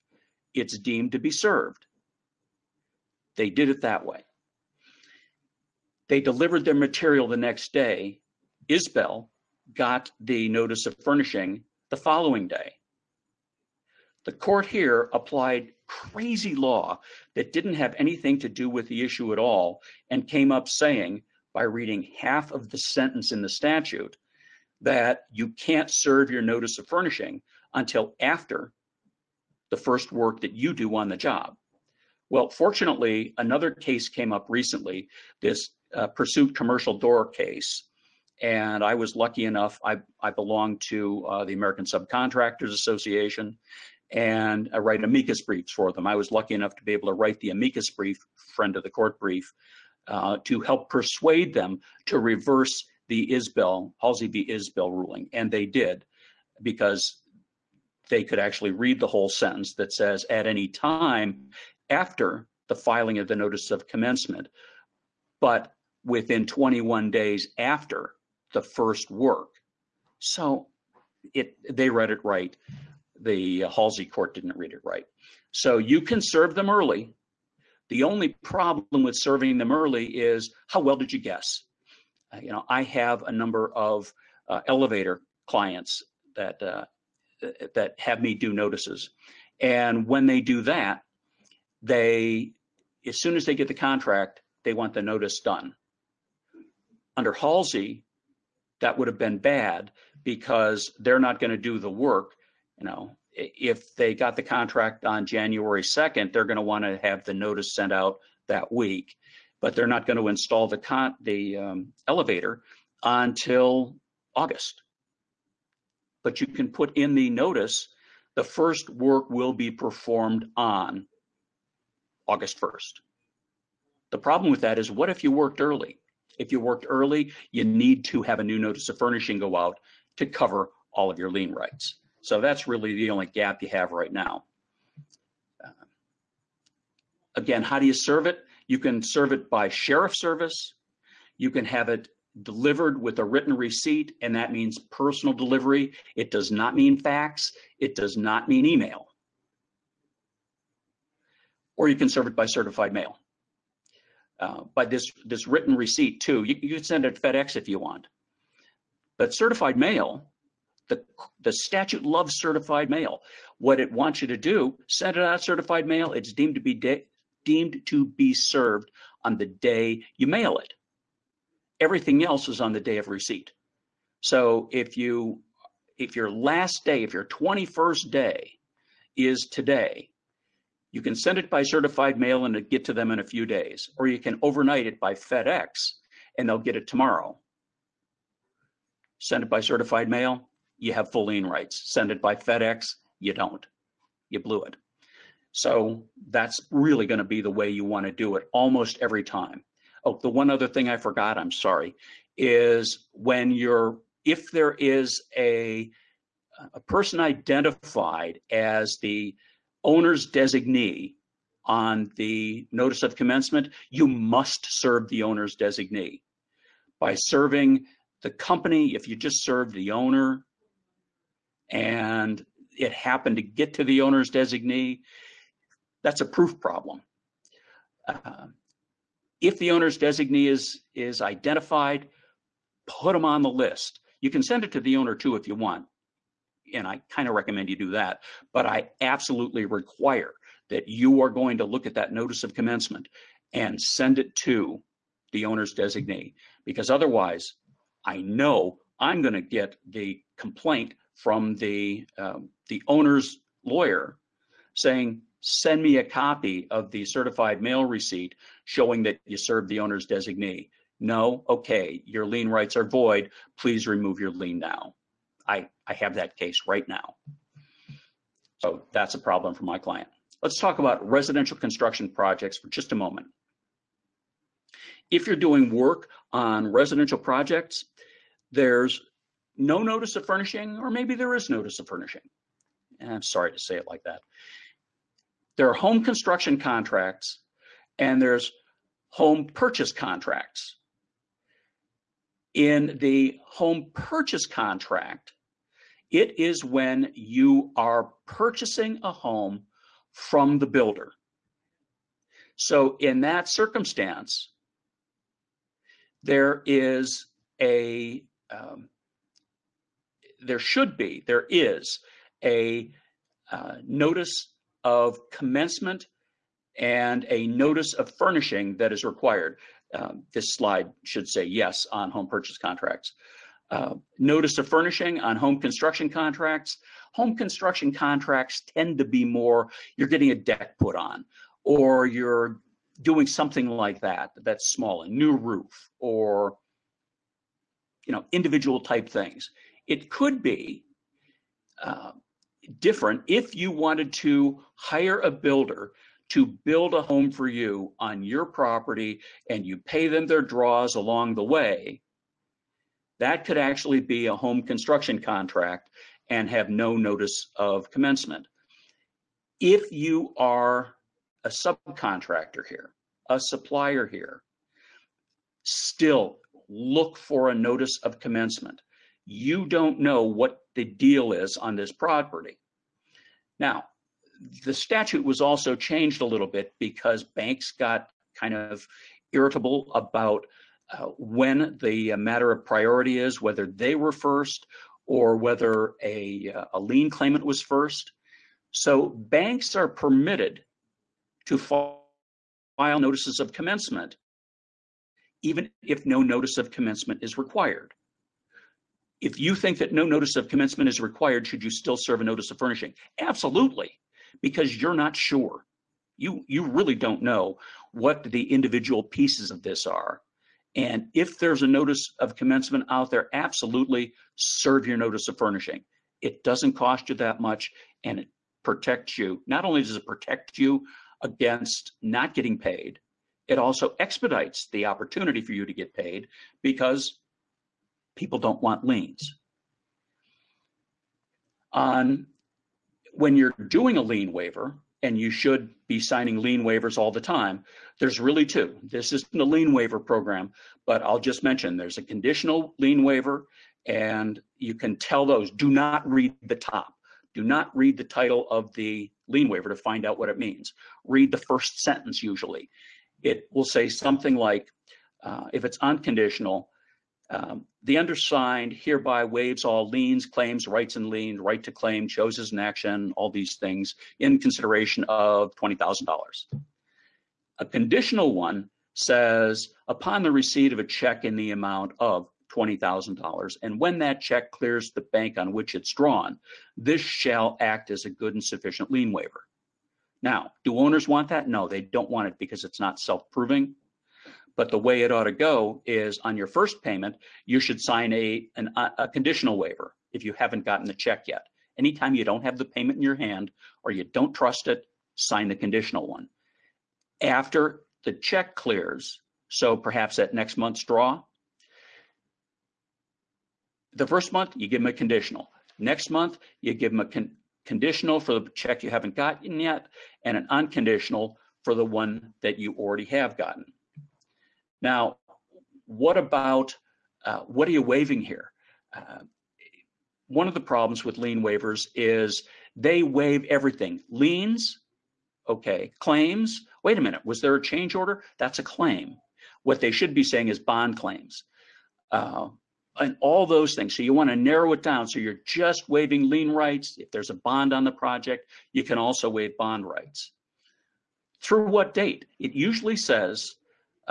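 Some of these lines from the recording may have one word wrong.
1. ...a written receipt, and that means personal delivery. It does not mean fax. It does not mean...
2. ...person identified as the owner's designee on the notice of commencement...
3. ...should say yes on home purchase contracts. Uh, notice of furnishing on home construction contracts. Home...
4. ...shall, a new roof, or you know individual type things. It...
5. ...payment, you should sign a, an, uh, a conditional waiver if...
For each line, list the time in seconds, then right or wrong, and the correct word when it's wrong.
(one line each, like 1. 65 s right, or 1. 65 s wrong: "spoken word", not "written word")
1. 143 s right
2. 206 s right
3. 321 s right
4. 334 s wrong: "small", not "shall"
5. 486 s right.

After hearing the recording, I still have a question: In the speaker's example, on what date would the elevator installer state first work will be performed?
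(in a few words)
August 1st.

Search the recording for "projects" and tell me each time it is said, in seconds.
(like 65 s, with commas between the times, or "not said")
272 s, 277 s, 537 s.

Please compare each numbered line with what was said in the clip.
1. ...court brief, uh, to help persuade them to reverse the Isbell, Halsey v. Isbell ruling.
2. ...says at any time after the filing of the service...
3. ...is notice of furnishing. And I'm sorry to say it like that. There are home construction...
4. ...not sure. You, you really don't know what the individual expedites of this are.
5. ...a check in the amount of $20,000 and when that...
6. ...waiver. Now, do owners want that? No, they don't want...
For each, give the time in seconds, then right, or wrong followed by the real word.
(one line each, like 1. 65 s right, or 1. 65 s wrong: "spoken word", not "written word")
1. 48 s right
2. 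59 s wrong: "notice", not "service"
3. 281 s right
4. 404 s wrong: "pieces", not "expedites"
5. 470 s right
6. 479 s right.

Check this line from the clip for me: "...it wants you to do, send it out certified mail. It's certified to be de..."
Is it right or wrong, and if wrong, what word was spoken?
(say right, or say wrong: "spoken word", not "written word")
wrong: "deemed", not "certified".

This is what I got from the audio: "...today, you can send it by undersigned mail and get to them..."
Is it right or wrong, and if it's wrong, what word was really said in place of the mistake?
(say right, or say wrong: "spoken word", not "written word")
wrong: "certified", not "undersigned".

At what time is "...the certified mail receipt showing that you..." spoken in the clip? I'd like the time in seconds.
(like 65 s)
256 s.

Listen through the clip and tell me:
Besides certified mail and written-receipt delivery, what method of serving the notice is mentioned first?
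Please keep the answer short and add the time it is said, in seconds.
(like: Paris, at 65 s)
sheriff service, at 139 s.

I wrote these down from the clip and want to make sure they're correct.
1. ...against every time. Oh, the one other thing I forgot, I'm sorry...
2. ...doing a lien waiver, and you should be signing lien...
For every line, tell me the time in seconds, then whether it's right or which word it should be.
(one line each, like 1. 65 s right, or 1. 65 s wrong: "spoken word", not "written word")
1. 198 s wrong: "almost", not "against"
2. 433 s right.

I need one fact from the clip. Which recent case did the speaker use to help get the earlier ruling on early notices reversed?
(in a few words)
Pursuit Commercial Door.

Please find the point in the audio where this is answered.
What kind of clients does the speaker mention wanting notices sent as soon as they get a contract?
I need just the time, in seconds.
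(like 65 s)
84 s.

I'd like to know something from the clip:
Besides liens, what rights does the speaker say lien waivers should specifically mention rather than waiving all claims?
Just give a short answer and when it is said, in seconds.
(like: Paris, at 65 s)
bond claims, at 530 s.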